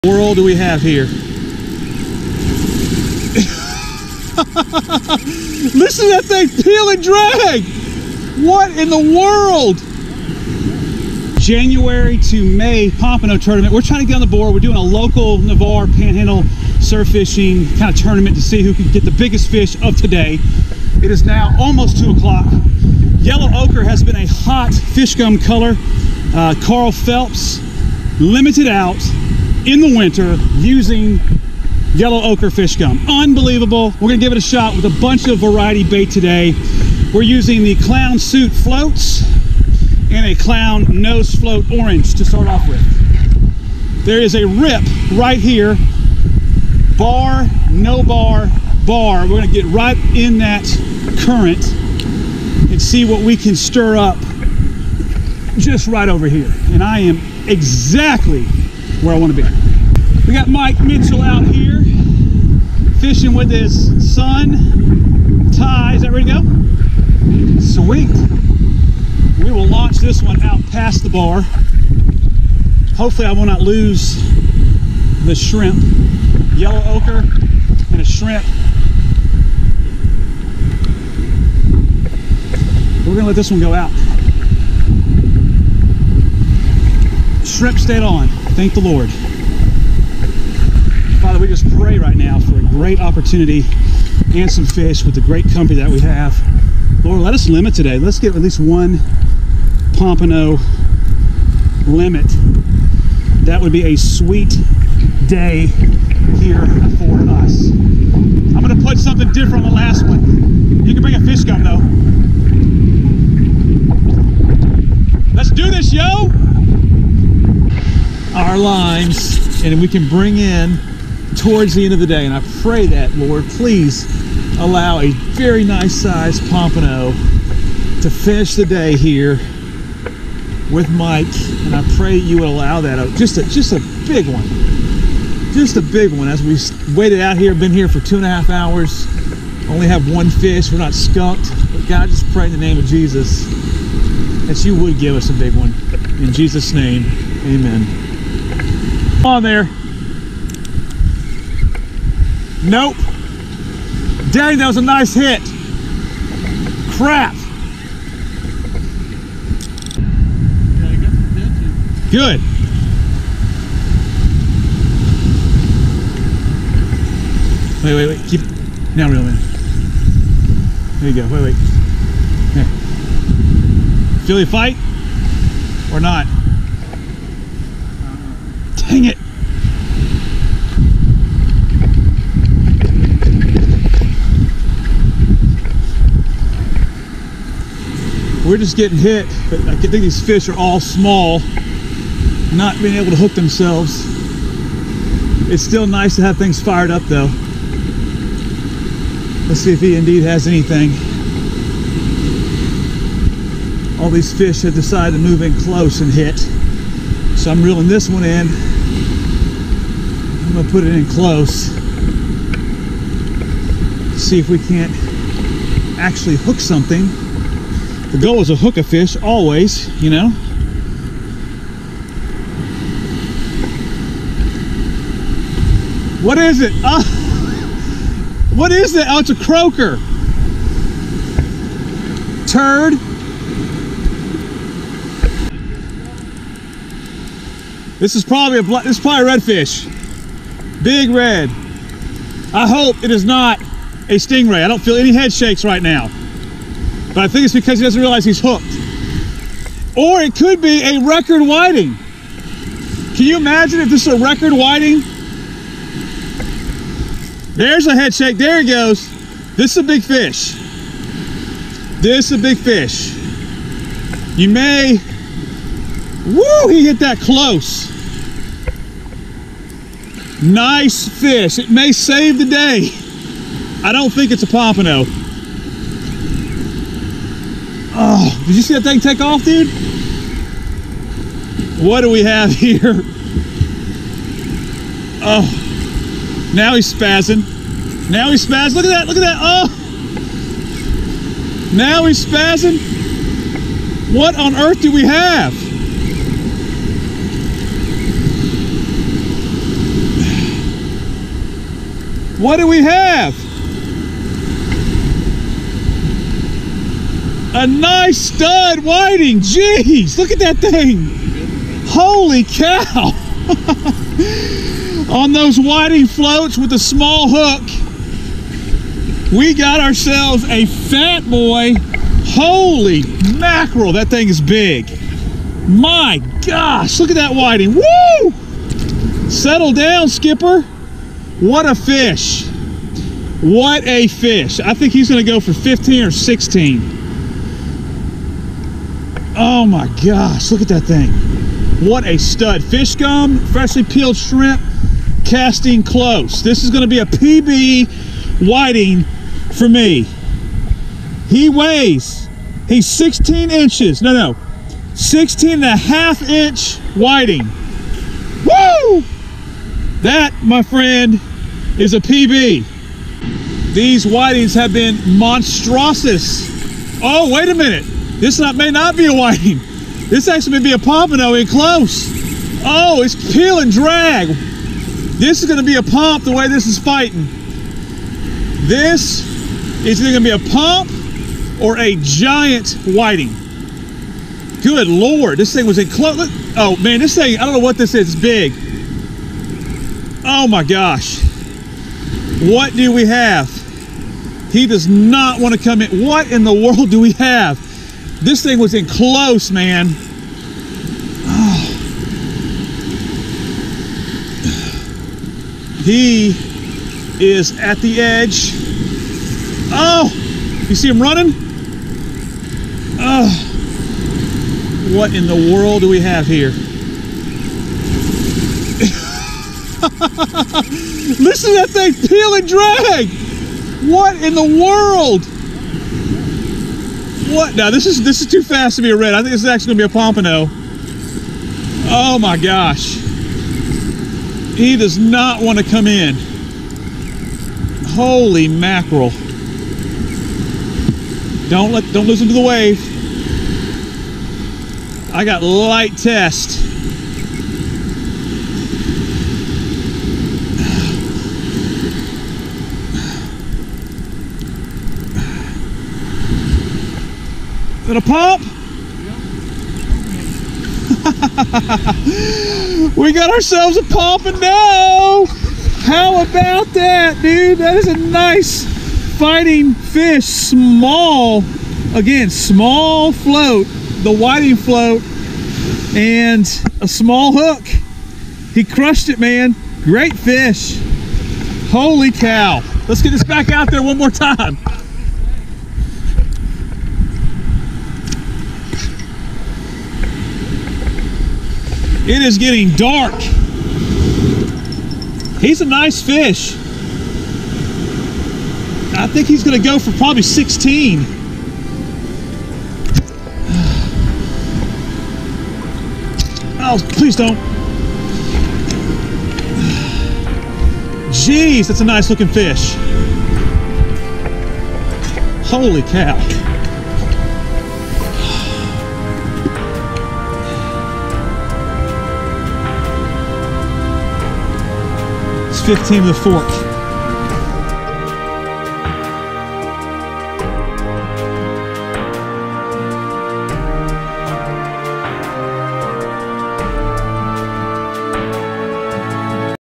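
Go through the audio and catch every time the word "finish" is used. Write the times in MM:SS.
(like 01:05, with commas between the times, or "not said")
02:08.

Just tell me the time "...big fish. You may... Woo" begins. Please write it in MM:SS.
04:22.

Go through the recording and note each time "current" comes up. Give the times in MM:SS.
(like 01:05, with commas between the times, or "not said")
00:51.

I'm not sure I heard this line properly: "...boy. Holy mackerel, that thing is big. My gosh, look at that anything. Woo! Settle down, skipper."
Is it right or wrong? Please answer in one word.
wrong.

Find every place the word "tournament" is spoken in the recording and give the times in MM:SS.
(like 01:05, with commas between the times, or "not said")
00:13, 00:18.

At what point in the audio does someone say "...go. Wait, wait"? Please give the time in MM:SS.
02:51.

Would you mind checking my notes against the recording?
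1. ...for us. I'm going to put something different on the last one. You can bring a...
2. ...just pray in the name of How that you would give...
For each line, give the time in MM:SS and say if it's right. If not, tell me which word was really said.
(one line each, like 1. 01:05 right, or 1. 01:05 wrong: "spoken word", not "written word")
1. 01:46 right
2. 02:22 wrong: "Jesus", not "How".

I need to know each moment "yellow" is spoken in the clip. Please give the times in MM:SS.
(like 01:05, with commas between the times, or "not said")
00:23, 00:31, 01:16.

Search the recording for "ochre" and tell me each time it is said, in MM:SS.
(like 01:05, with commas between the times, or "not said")
00:23, 00:32, 01:16.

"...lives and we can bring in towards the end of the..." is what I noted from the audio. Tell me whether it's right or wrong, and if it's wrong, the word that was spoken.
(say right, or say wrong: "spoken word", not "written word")
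right.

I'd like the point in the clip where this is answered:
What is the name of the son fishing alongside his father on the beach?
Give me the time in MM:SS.
01:05.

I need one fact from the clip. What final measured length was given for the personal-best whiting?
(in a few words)
16.5 inches.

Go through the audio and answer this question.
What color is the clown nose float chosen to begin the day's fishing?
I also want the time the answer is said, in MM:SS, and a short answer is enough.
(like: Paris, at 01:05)
Orange, at 00:41.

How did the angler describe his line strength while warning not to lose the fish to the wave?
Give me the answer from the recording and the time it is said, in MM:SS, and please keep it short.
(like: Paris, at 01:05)
Light test, at 07:25.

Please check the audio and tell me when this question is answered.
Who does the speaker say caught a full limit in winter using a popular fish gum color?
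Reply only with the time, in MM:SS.
00:26.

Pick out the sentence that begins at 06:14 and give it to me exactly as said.
This is gonna be a pump the way this is fighting.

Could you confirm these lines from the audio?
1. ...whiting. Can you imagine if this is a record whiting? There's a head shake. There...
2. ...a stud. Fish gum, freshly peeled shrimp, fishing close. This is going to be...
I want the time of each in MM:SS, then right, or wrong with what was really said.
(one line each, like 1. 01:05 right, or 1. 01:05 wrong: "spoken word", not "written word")
1. 04:11 right
2. 05:42 wrong: "casting", not "fishing".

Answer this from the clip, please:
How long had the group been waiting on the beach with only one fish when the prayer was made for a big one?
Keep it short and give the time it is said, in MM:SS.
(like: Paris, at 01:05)
Two and a half hours, at 02:18.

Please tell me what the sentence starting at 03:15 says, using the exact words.
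It's still nice to have things fired up though.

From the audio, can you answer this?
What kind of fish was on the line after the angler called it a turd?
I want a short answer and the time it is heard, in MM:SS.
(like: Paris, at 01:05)
Croaker, at 03:49.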